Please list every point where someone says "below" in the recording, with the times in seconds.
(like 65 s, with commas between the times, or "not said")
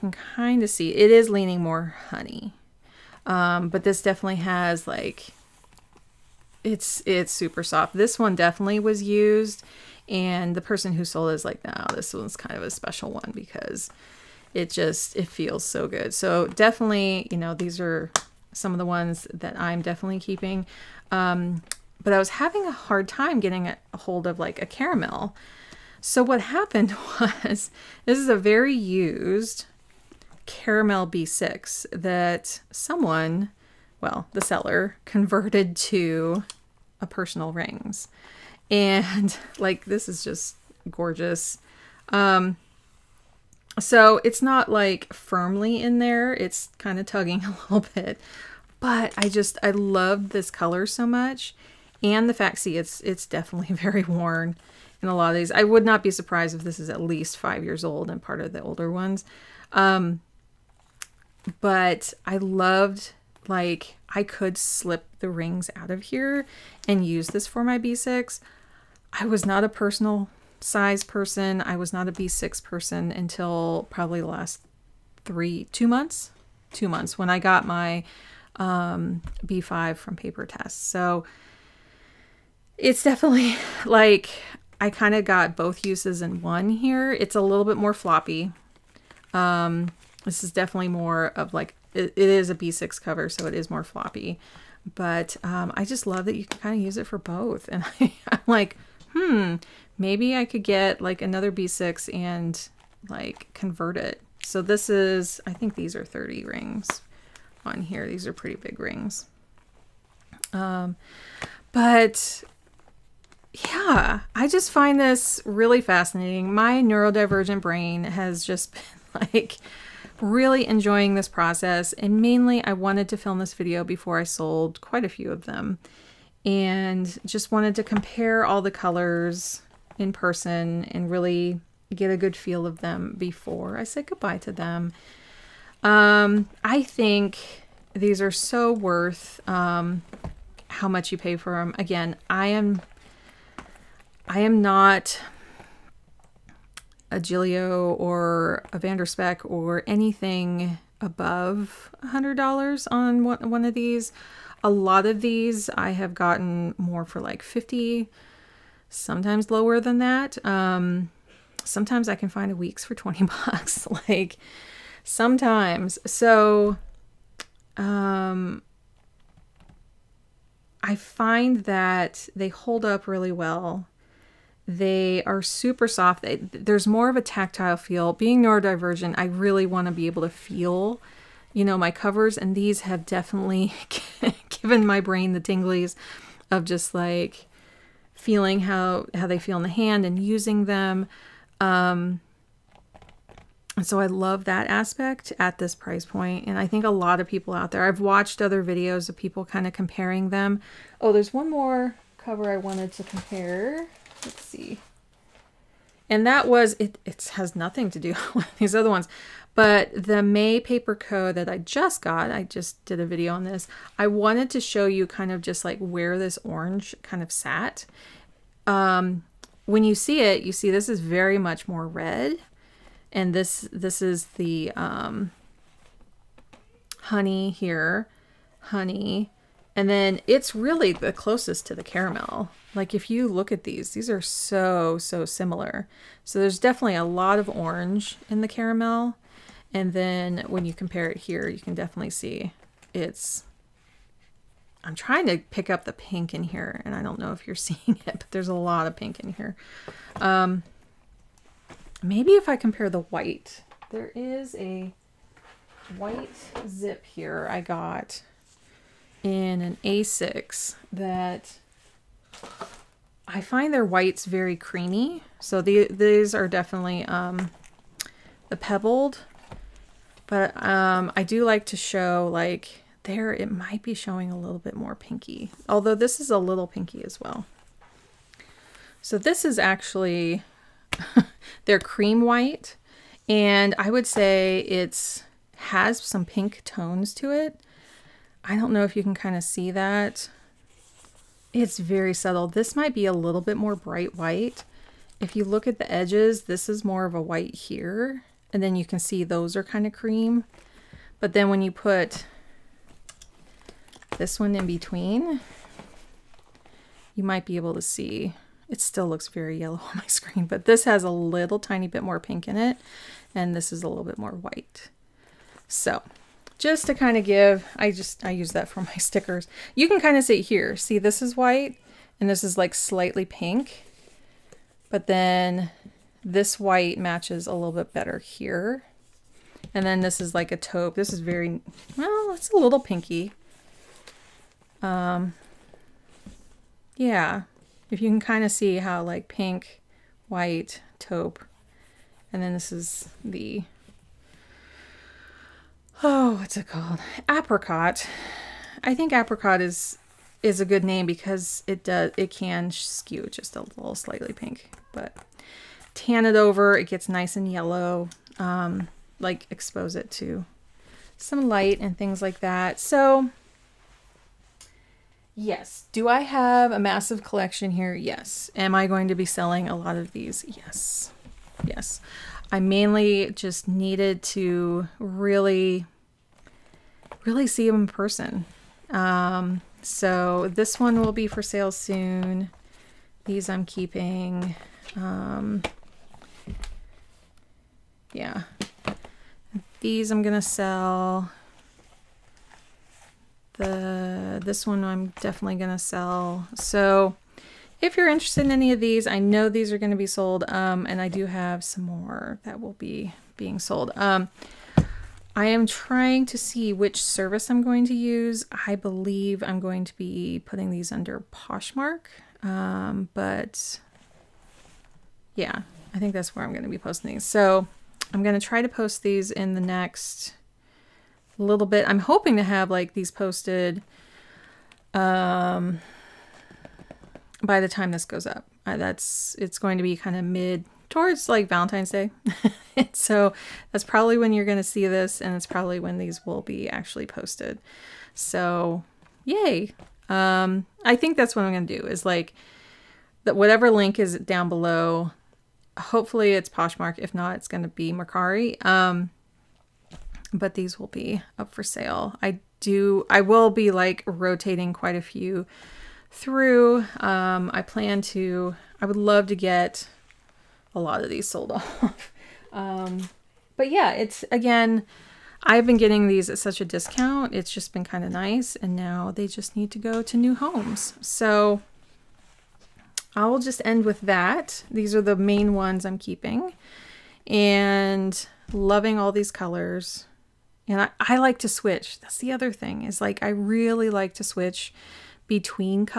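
444 s.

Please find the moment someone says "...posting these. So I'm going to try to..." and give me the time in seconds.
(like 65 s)
416 s.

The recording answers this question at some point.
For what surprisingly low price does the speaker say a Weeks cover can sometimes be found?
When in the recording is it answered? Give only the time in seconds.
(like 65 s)
162 s.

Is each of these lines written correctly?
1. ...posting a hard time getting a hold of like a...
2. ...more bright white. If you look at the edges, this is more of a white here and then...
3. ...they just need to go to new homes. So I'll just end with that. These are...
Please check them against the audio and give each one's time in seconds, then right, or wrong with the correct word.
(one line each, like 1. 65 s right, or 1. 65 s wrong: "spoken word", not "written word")
1. 22 s wrong: "having", not "posting"
2. 293 s right
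3. 469 s right.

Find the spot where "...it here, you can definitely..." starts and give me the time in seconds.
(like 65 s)
241 s.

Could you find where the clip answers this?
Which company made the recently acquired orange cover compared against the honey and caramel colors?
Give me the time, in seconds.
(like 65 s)
210 s.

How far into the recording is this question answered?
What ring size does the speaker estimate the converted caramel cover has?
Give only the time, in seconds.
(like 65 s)
106 s.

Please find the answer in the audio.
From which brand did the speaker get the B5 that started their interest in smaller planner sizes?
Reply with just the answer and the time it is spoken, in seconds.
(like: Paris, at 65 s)
Papertess, at 80 s.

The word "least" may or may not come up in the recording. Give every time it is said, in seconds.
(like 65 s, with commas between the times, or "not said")
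57 s.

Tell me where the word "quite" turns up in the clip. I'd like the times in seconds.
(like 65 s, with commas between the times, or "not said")
124 s, 454 s.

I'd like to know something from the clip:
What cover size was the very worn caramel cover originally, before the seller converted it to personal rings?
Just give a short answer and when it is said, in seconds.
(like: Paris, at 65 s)
B6, at 30 s.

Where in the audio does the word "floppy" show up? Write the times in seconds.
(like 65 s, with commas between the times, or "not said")
87 s, 93 s.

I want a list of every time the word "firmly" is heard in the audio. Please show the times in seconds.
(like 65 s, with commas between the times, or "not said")
45 s.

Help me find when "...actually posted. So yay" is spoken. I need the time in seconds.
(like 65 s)
436 s.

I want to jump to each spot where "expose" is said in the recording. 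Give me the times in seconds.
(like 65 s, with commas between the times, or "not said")
359 s.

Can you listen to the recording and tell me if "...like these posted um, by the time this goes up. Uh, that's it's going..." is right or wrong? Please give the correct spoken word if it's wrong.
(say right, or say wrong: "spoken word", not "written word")
right.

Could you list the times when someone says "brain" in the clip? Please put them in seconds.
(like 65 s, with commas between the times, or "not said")
117 s, 184 s.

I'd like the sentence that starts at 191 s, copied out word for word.
Um, so I love that aspect at this price point.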